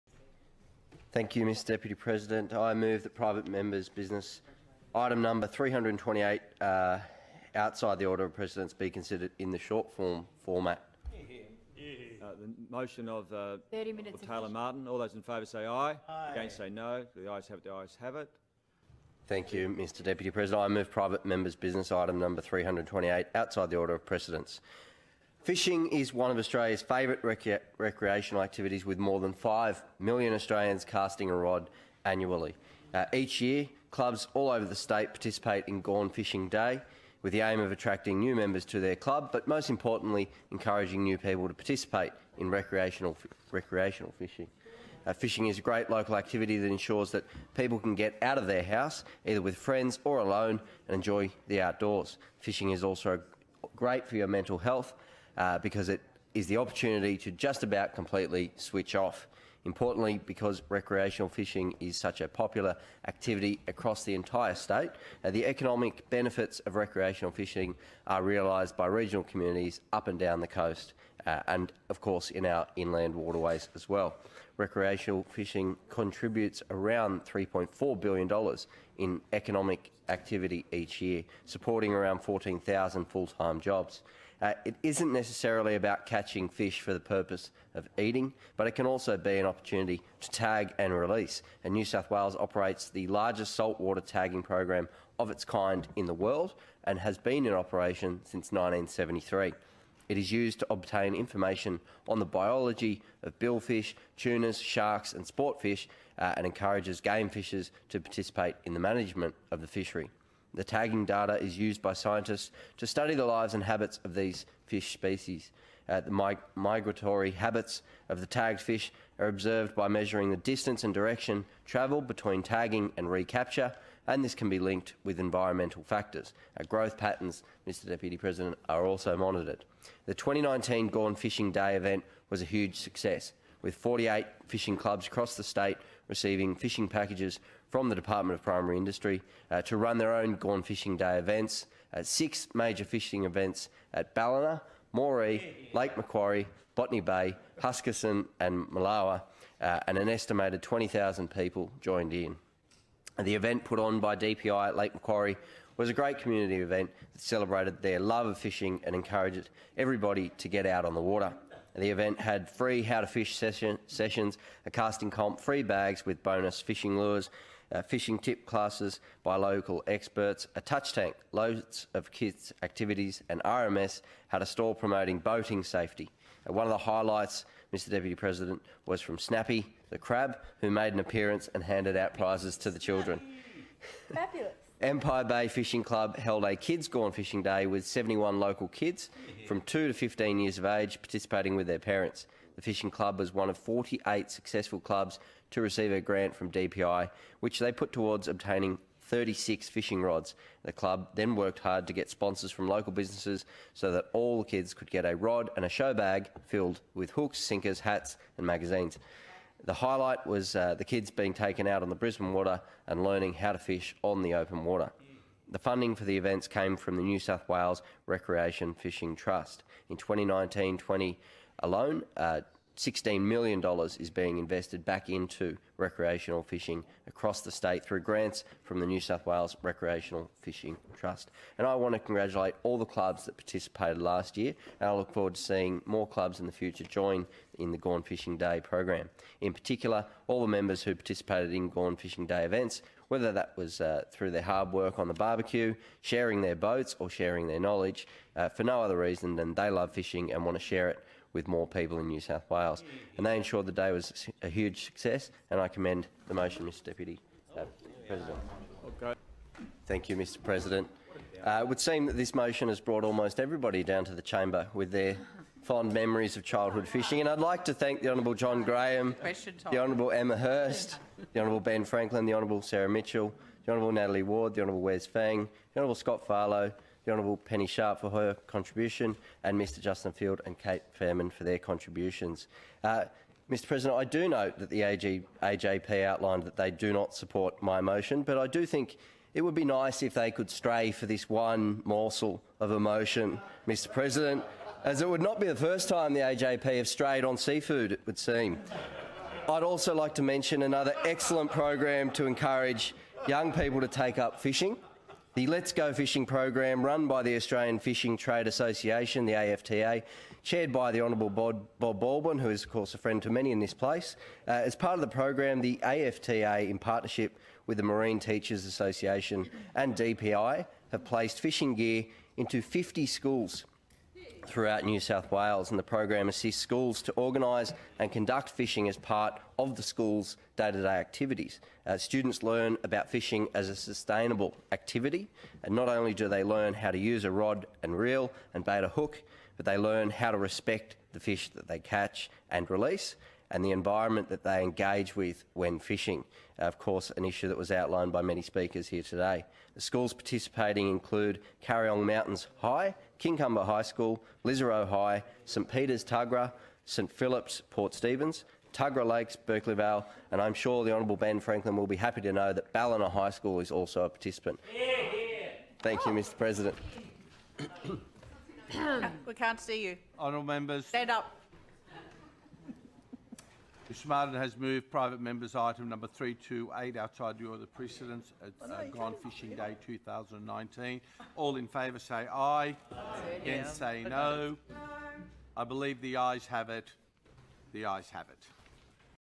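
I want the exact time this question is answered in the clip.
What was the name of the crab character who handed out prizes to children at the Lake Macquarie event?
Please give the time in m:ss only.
2:59.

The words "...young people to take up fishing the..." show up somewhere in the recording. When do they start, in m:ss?
5:03.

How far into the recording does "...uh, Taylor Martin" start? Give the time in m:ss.
0:13.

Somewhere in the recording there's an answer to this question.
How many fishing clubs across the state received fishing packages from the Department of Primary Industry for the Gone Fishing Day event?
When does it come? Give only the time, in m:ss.
2:13.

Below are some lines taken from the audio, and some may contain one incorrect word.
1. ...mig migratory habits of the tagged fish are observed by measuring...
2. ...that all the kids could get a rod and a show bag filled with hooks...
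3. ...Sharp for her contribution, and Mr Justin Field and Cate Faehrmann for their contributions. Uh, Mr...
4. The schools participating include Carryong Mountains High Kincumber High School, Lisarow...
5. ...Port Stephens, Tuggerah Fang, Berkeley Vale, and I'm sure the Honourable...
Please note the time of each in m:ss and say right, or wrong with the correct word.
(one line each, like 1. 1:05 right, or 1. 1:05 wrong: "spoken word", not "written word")
1. 1:56 right
2. 3:23 right
3. 4:37 right
4. 5:49 right
5. 5:57 wrong: "Lakes", not "Fang".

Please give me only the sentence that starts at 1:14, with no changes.
Recreational fishing contributes around $3.4 billion in economic activity each year, supporting around 14,000 full-time jobs.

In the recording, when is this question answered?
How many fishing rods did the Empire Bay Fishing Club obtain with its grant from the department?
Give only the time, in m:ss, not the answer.
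3:19.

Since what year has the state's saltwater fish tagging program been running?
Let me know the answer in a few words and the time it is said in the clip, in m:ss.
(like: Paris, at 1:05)
1973, at 1:38.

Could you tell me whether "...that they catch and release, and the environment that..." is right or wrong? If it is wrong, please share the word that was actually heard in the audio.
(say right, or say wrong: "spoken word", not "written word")
right.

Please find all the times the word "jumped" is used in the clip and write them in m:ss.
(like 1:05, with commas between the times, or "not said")
not said.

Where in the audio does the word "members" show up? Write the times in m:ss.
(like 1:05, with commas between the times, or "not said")
0:03, 0:21, 0:38, 4:00, 6:10, 6:15.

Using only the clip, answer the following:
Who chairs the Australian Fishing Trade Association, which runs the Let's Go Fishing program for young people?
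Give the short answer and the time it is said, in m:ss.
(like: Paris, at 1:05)
Bob Baldwin, at 5:11.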